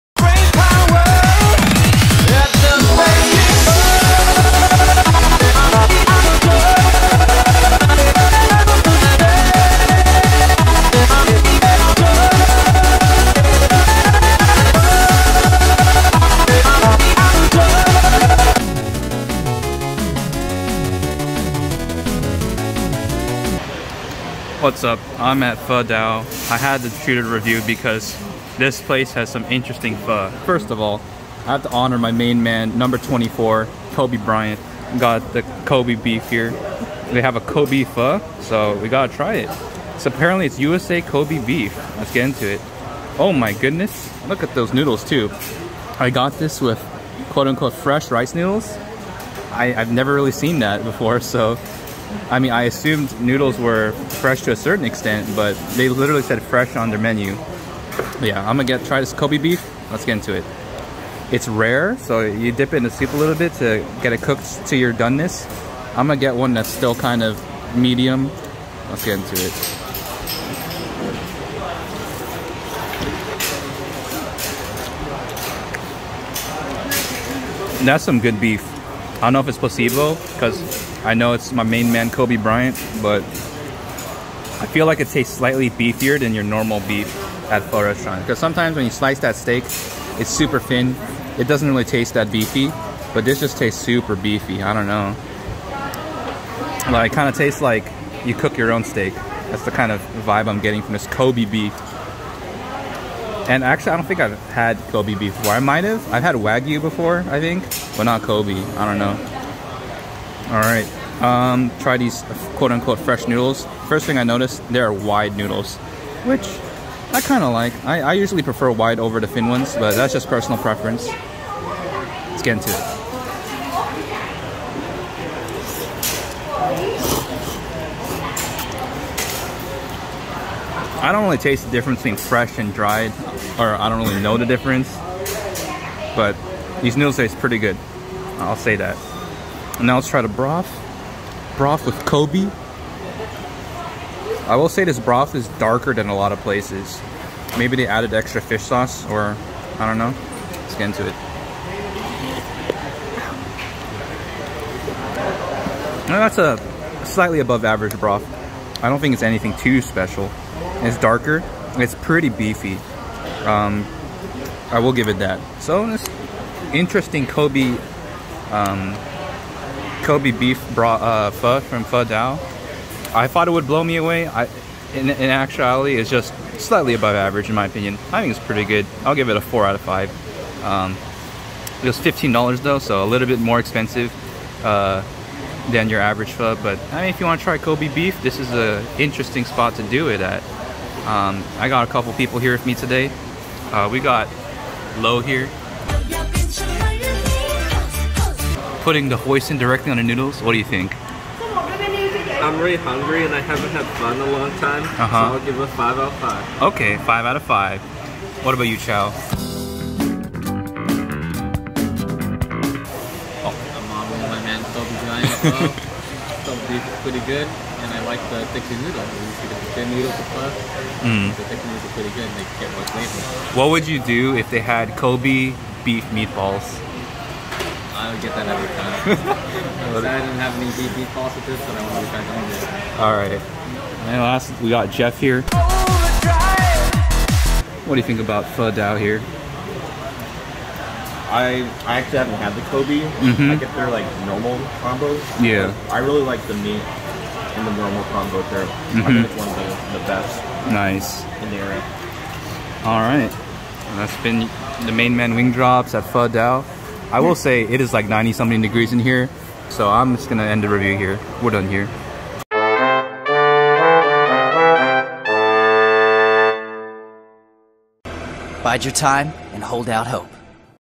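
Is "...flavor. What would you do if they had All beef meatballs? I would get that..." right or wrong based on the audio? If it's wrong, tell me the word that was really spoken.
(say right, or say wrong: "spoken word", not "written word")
wrong: "Kobe", not "All".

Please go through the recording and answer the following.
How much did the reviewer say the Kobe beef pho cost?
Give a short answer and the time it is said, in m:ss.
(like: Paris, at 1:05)
$15, at 3:01.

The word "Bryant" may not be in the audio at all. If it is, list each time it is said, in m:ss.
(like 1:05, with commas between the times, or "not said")
0:34, 1:22, 3:35.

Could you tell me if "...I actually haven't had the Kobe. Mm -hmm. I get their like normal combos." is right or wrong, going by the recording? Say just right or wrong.
right.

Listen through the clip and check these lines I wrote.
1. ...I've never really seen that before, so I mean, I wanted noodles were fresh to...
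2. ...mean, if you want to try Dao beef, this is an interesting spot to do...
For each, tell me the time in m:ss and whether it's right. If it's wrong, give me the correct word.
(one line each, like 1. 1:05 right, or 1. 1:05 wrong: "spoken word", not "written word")
1. 0:49 wrong: "assumed", not "wanted"
2. 3:07 wrong: "Kobe", not "Dao".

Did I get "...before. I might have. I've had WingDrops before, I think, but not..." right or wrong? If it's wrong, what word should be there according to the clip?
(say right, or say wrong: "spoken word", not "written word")
wrong: "Wagyu", not "WingDrops".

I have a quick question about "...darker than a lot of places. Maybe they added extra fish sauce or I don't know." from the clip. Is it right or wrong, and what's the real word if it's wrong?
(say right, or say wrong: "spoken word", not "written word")
right.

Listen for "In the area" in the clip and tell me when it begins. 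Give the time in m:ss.
4:11.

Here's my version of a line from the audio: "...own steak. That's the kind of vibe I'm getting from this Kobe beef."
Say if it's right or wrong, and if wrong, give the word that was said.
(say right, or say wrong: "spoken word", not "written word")
right.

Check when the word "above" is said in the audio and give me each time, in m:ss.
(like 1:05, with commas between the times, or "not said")
2:37, 2:56.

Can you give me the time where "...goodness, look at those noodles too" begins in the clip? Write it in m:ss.
0:43.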